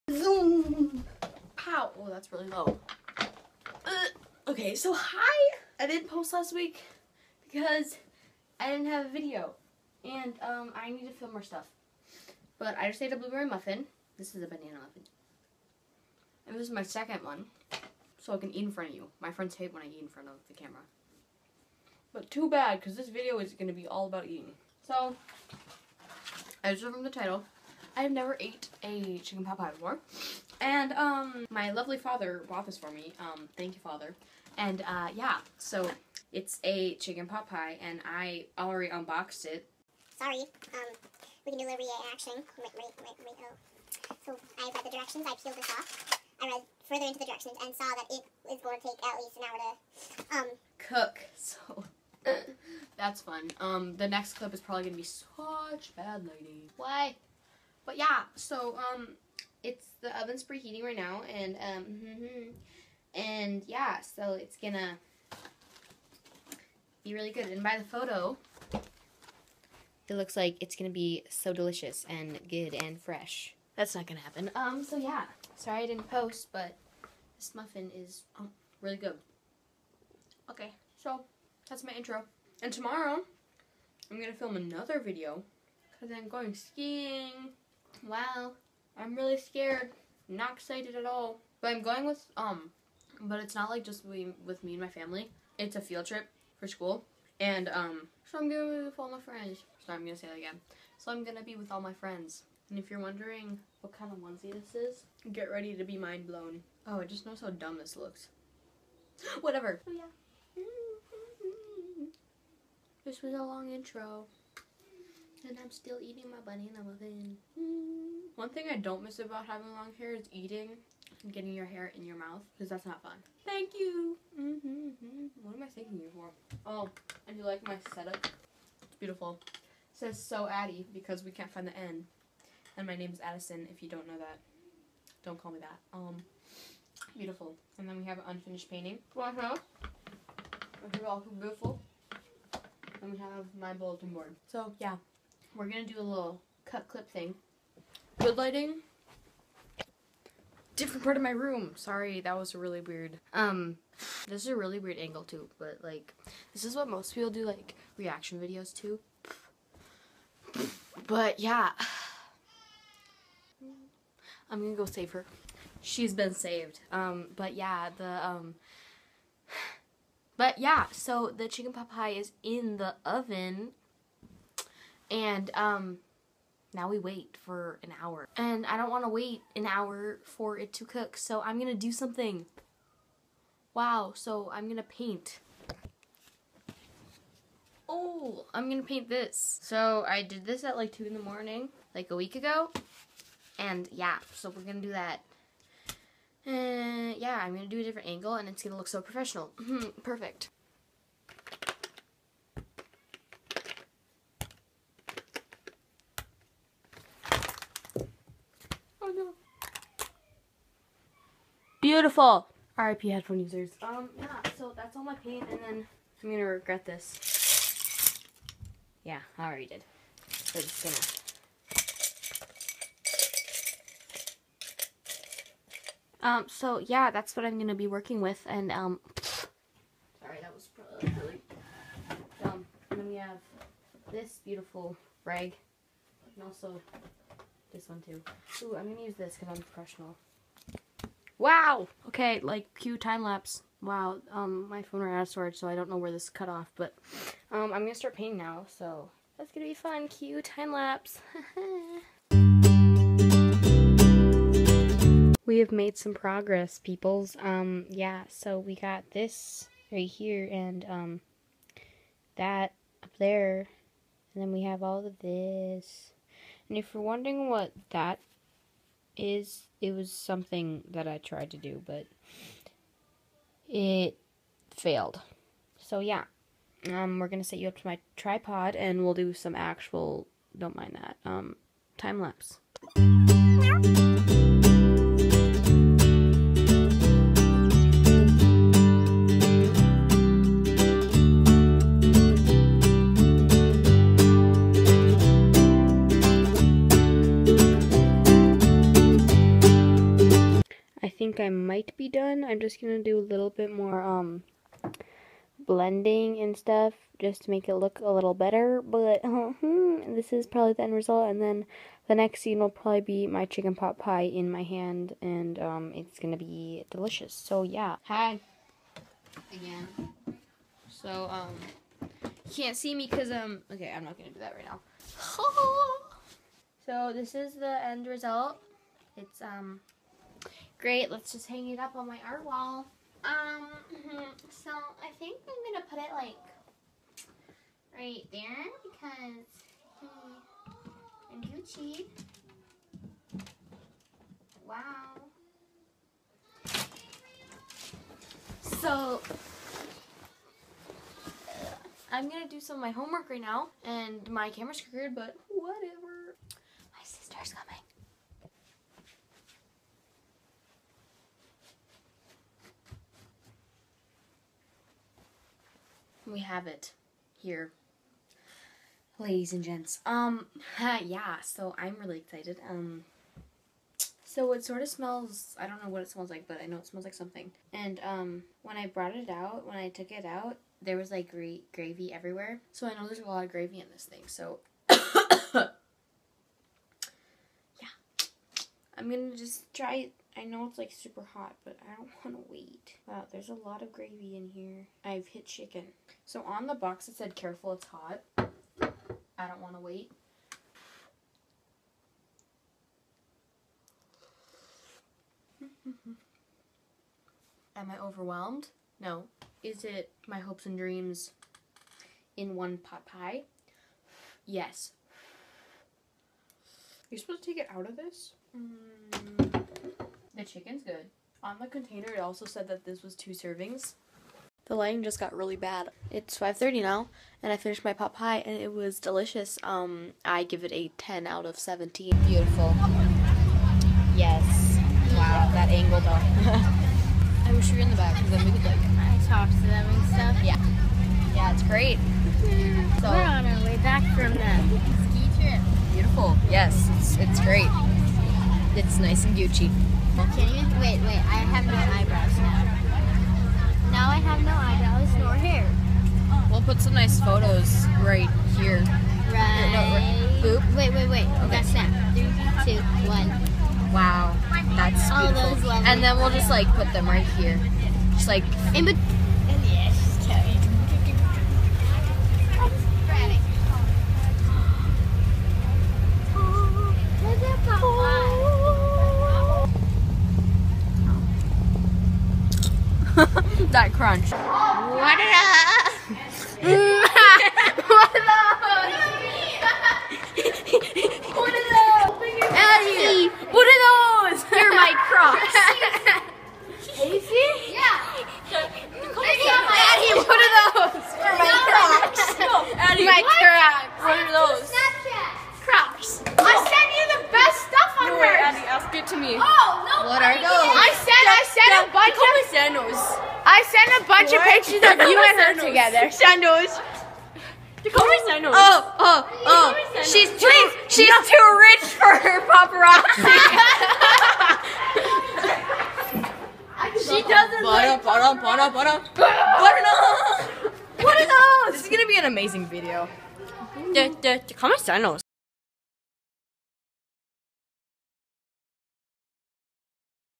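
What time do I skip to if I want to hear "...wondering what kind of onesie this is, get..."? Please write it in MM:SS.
01:42.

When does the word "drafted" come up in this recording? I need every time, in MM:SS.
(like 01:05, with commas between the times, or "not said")
not said.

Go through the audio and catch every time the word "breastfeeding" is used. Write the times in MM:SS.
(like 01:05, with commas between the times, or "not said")
not said.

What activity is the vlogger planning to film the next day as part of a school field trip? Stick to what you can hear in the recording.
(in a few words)
skiing.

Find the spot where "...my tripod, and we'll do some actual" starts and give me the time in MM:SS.
04:37.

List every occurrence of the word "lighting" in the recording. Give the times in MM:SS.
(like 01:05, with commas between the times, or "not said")
02:28, 07:04.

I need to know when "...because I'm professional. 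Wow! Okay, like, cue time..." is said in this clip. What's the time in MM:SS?
03:59.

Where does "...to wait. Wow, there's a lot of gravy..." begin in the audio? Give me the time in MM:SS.
06:32.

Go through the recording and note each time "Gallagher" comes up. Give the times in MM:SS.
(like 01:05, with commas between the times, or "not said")
not said.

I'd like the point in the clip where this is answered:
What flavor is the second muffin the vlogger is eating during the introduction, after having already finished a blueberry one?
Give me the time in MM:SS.
00:14.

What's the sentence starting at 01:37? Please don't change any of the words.
And, um, so I'm going to be with all my friends.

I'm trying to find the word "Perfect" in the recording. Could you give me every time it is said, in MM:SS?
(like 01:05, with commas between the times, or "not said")
03:20.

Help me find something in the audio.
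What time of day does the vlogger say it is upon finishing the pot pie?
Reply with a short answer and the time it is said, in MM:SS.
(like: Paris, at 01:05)
5:30, at 07:06.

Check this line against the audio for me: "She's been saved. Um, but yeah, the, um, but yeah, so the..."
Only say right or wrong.
right.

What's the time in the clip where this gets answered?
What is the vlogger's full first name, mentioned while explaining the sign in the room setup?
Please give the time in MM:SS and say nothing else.
02:12.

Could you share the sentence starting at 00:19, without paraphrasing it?
My friends hate when I eat in front of the camera.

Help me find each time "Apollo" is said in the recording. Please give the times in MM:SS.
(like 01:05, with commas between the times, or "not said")
not said.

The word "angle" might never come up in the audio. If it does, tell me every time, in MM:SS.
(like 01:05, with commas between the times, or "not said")
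02:34, 03:18, 07:15.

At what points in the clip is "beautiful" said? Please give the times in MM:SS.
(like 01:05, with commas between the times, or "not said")
02:08, 02:17, 02:21, 03:31, 03:54, 07:12, 07:25, 07:45.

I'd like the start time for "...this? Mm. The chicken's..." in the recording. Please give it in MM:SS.
06:57.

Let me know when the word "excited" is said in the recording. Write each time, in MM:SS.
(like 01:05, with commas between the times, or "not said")
01:30, 06:12.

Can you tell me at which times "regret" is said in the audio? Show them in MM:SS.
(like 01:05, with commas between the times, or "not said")
03:36.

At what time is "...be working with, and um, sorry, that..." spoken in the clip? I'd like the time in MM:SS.
03:47.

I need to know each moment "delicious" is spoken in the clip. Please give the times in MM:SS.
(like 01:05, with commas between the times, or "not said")
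01:11, 05:16, 07:08.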